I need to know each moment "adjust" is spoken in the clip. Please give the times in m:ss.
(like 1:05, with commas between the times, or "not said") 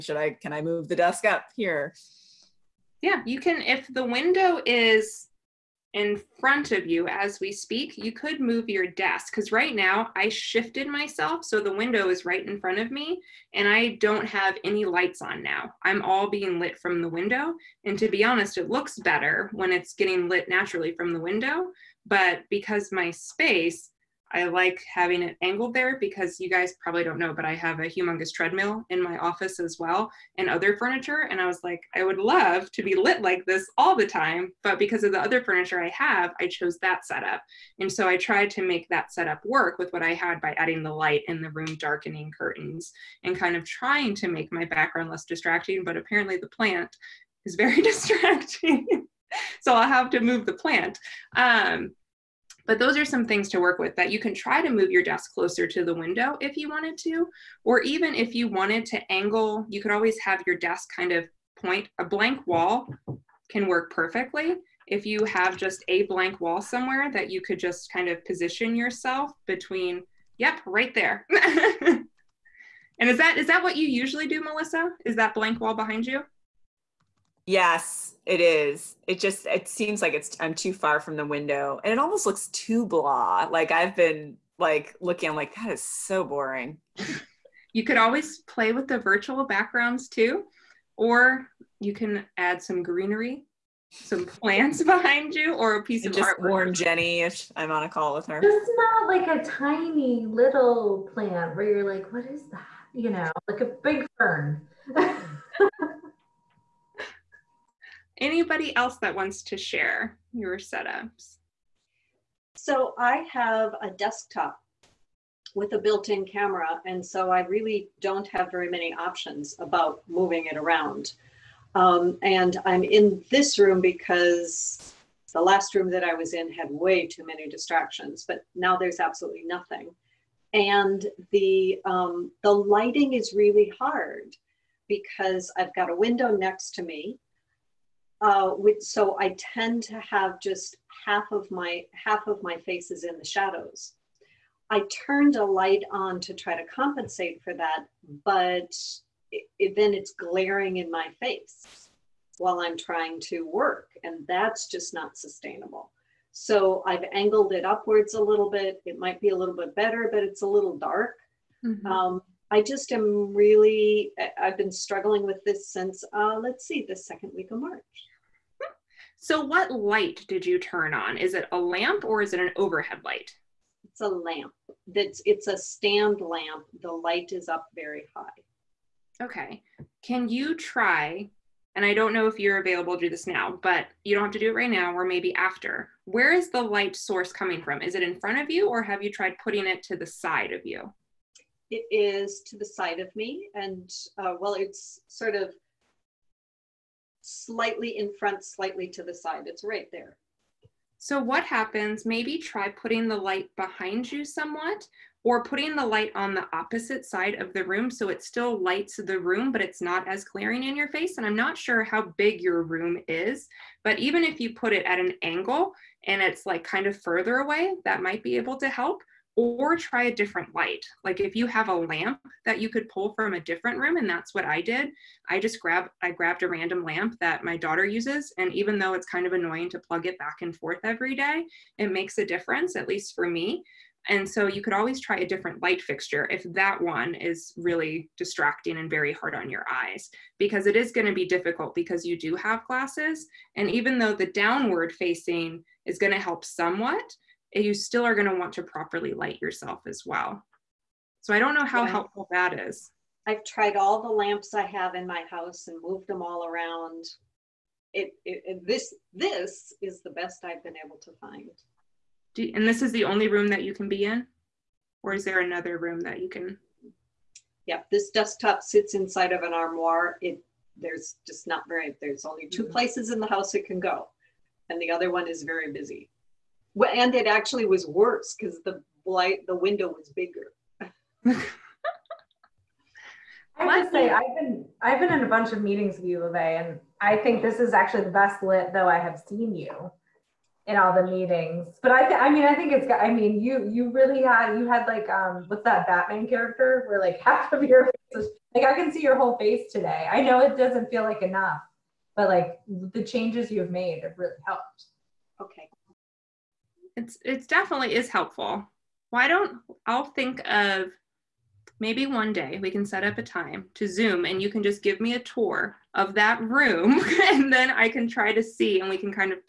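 not said.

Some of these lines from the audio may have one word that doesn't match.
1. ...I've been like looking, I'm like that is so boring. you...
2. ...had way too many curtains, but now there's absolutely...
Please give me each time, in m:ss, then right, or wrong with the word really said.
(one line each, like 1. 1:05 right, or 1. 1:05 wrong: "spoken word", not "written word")
1. 1:23 right
2. 2:06 wrong: "distractions", not "curtains".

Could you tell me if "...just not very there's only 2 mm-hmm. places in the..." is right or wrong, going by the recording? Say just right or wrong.
right.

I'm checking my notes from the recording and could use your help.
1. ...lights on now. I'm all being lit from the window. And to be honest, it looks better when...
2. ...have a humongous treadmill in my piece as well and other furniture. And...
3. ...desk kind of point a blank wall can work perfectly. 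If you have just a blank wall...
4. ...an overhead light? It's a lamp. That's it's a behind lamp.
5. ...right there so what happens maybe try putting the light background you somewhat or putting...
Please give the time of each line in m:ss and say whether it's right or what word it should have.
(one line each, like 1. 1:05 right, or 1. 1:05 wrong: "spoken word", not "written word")
1. 0:14 right
2. 0:27 wrong: "office", not "piece"
3. 1:00 right
4. 2:52 wrong: "stand", not "behind"
5. 3:19 wrong: "behind", not "background".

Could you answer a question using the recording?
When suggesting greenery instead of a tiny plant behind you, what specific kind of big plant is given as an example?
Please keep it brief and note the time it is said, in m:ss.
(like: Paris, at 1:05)
fern, at 1:44.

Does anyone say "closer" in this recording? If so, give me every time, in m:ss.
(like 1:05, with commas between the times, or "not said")
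0:55.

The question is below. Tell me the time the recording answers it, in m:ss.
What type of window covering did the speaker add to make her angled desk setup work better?
0:41.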